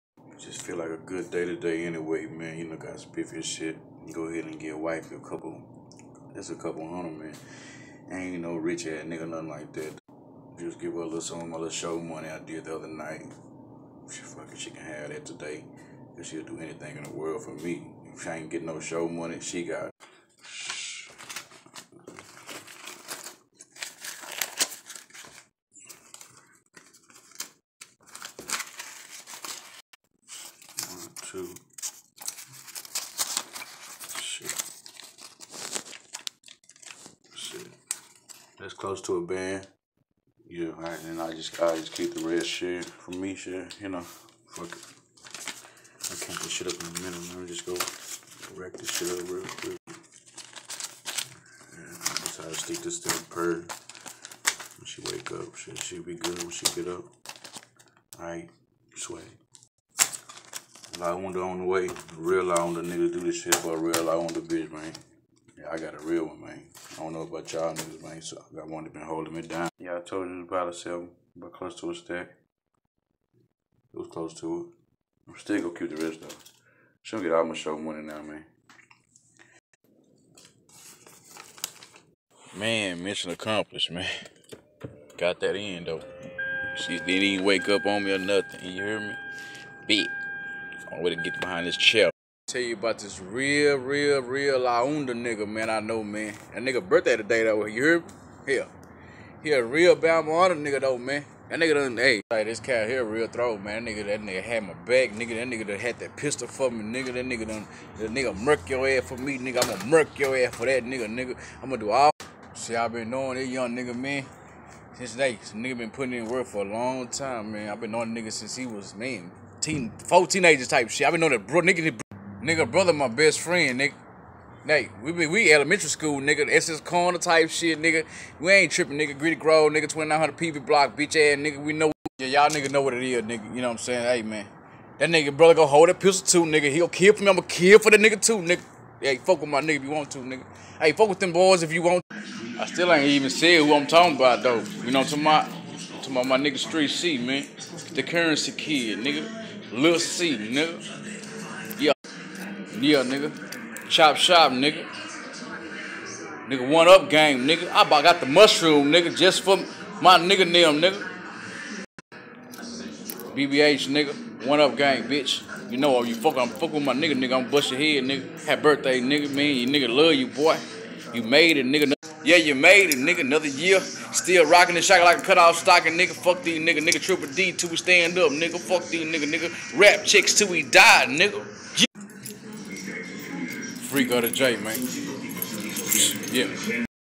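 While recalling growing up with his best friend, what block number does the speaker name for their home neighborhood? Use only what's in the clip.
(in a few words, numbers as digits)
2900.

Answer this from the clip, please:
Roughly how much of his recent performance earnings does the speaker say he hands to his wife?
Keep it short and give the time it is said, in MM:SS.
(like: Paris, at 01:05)
a couple hundred, at 00:06.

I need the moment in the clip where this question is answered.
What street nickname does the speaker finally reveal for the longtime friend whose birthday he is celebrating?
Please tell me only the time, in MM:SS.
02:26.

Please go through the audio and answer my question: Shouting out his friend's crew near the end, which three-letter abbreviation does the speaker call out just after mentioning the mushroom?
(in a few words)
BBH.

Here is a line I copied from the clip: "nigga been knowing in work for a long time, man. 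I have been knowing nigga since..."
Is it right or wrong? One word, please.
wrong.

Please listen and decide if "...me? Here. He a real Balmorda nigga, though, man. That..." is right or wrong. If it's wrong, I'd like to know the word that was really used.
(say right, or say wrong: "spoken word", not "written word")
right.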